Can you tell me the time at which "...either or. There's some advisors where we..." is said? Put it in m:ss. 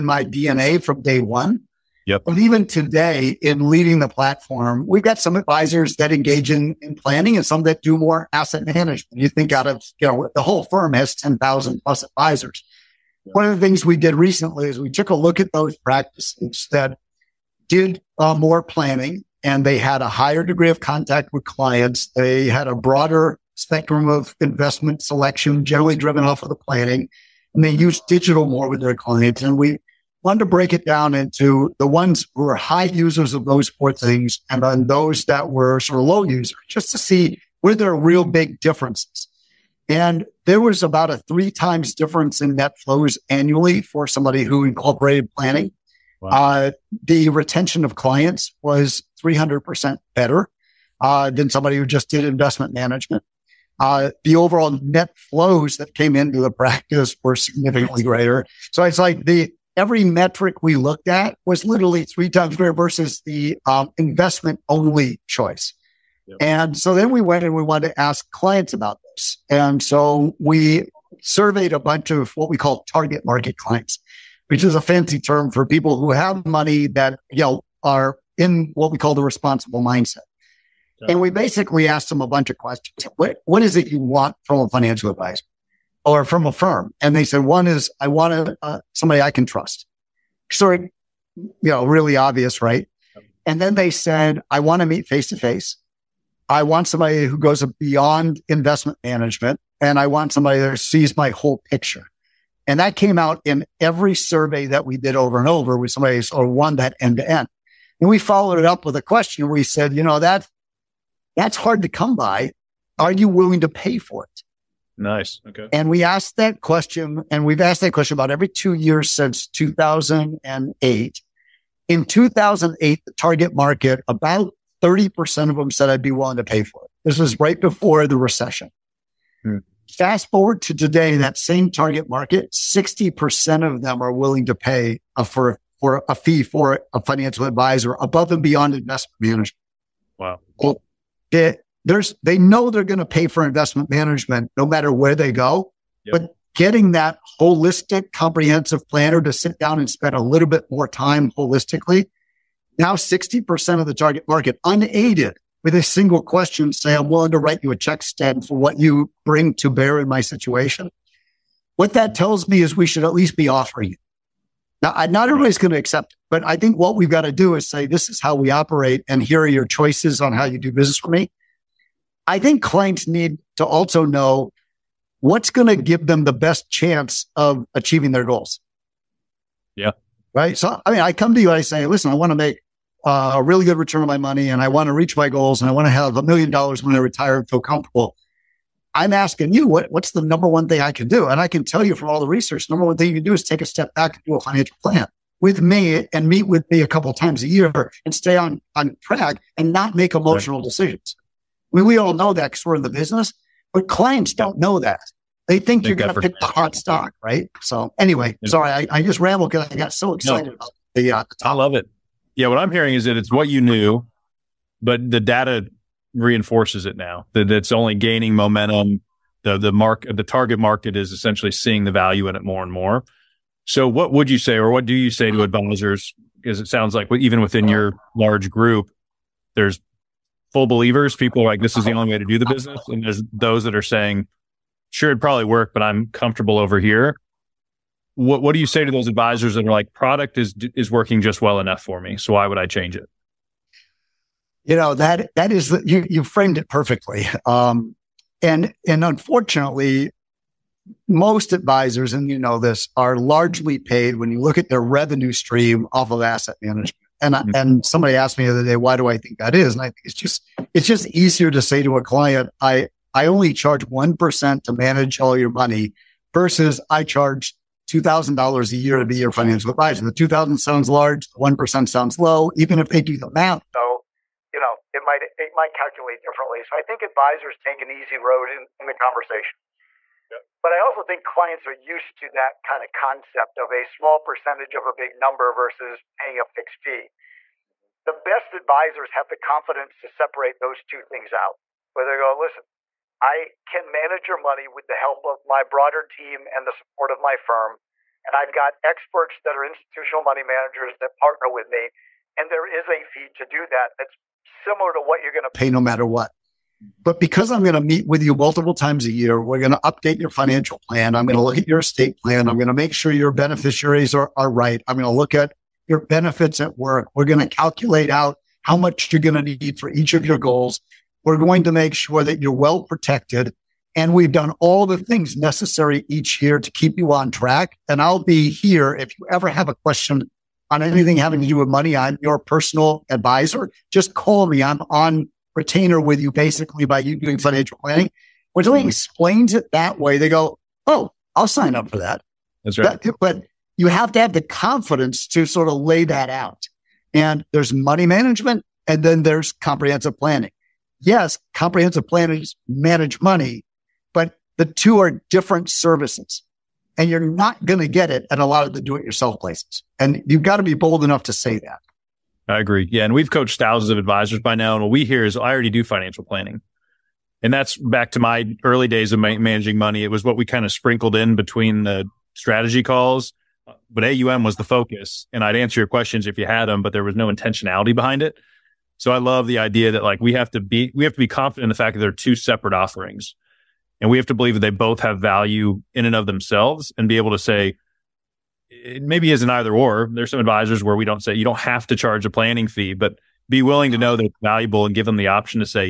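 6:29.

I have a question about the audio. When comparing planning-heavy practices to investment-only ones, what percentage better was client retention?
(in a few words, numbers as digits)
300%.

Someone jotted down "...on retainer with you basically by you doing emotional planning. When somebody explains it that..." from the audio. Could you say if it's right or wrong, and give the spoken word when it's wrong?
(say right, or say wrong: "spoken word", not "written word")
wrong: "financial", not "emotional".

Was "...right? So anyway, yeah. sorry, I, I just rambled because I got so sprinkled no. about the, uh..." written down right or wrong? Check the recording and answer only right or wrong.
wrong.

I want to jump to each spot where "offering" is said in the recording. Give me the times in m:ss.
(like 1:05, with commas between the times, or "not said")
2:43, 6:22.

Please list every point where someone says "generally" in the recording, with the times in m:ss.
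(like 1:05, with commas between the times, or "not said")
0:25.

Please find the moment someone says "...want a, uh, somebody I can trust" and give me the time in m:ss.
1:28.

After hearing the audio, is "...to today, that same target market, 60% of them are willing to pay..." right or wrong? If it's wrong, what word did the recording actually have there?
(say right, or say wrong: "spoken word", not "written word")
right.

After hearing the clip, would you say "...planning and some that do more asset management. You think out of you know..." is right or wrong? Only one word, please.
right.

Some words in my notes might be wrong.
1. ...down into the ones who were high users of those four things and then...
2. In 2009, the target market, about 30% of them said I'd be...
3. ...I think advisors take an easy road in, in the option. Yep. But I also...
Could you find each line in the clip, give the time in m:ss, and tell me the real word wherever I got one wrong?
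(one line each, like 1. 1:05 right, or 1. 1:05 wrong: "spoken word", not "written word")
1. 0:30 right
2. 2:01 wrong: "2008", not "2009"
3. 4:36 wrong: "conversation", not "option".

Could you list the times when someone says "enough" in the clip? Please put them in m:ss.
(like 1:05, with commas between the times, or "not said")
4:01, 6:01.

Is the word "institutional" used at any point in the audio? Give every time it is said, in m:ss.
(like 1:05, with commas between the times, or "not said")
4:59.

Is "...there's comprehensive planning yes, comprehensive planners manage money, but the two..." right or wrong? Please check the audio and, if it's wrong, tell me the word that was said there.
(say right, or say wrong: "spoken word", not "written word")
right.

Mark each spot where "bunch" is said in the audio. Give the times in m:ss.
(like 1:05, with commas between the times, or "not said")
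1:11, 1:22.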